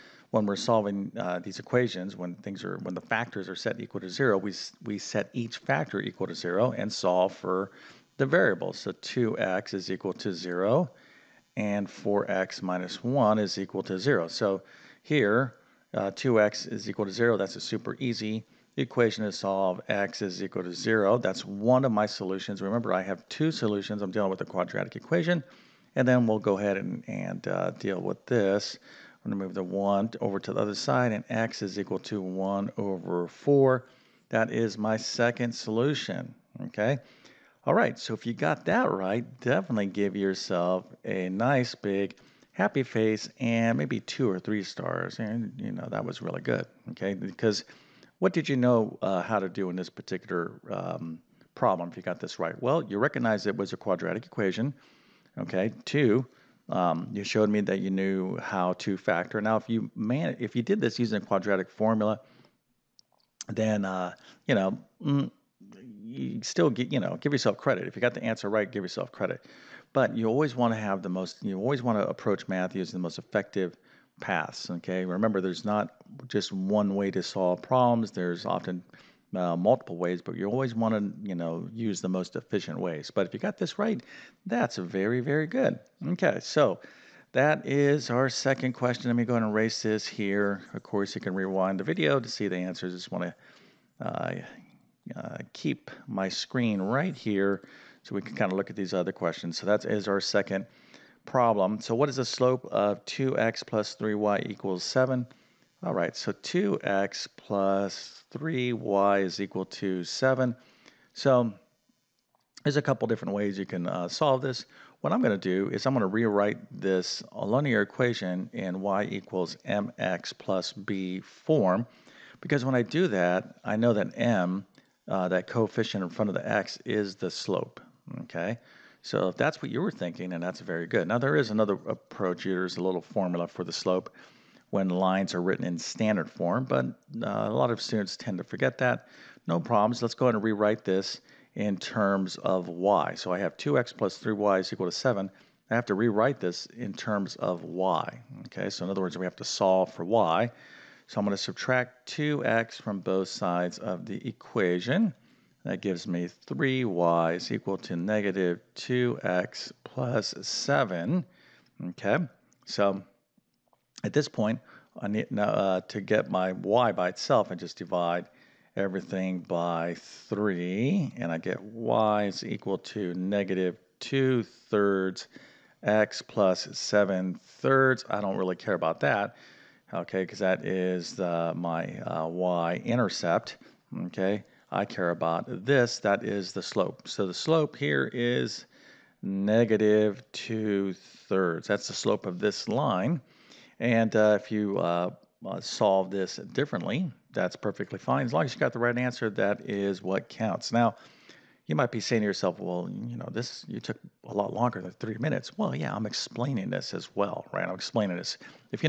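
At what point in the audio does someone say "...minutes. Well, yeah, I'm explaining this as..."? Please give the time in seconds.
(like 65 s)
205 s.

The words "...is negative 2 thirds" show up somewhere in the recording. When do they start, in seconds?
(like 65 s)
188 s.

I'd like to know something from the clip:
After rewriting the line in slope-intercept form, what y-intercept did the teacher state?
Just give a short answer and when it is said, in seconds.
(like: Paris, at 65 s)
7/3, at 176 s.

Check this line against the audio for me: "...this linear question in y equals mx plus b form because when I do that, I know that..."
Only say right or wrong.
wrong.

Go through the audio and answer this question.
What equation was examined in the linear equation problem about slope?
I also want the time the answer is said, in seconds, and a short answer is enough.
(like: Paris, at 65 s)
2x + 3y = 7, at 103 s.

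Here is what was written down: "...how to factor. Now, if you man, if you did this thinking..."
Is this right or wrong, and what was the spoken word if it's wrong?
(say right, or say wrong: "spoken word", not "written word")
wrong: "using", not "thinking".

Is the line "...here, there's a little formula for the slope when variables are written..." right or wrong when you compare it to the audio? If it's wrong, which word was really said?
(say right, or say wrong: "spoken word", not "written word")
wrong: "lines", not "variables".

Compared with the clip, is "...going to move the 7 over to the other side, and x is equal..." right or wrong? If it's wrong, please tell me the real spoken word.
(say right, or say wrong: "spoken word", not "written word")
wrong: "1", not "7".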